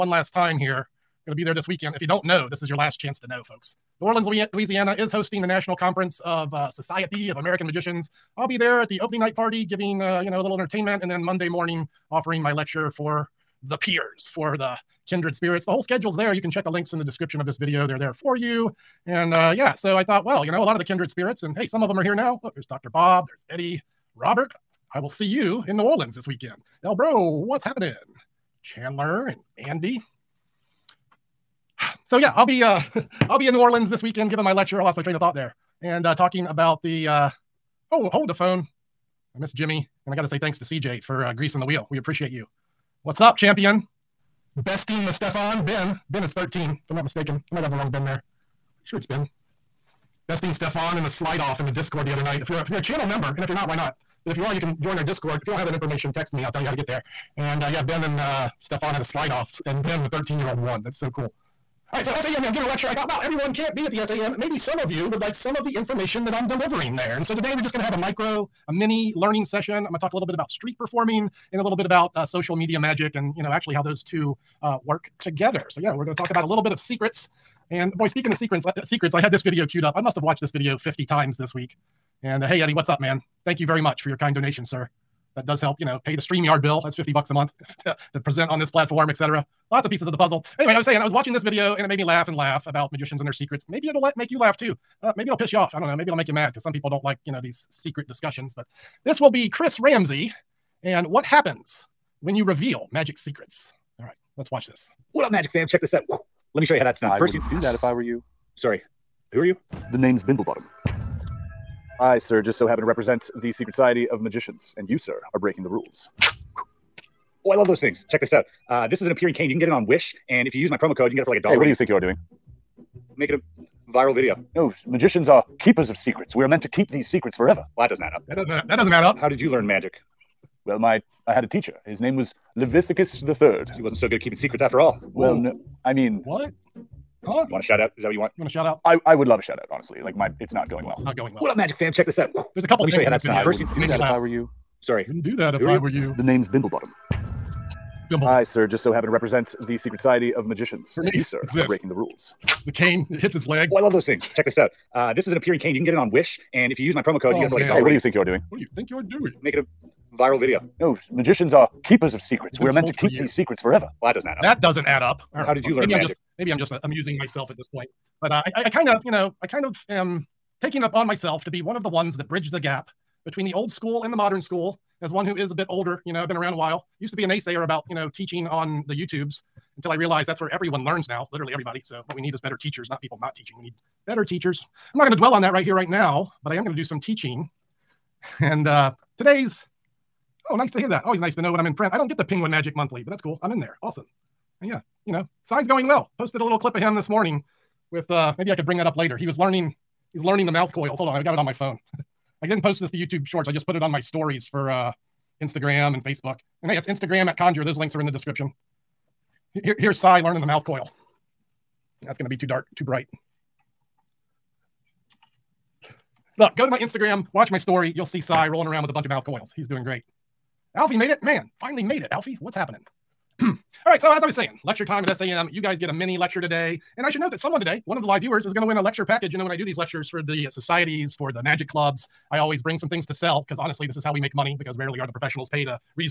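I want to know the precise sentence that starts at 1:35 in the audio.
Uh, maybe it'll piss you off.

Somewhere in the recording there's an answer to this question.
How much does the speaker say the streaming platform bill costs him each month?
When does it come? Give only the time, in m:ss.
1:26.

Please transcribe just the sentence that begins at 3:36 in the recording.
Look, go to my Instagram, watch my story.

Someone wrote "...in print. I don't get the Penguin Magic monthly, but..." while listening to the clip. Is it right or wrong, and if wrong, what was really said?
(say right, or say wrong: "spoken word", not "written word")
right.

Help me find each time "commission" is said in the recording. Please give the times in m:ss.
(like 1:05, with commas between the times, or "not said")
not said.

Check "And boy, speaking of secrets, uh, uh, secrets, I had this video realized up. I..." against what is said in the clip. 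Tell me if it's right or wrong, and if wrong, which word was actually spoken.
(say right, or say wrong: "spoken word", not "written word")
wrong: "queued", not "realized".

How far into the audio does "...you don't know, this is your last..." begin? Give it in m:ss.
0:01.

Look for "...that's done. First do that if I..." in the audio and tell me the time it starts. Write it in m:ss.
2:23.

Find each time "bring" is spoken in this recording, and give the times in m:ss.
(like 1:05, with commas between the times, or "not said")
3:18, 3:52.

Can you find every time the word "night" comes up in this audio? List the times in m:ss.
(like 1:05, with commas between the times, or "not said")
0:09, 0:52.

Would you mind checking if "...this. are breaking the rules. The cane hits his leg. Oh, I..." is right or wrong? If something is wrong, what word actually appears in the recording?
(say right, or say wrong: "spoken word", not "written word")
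right.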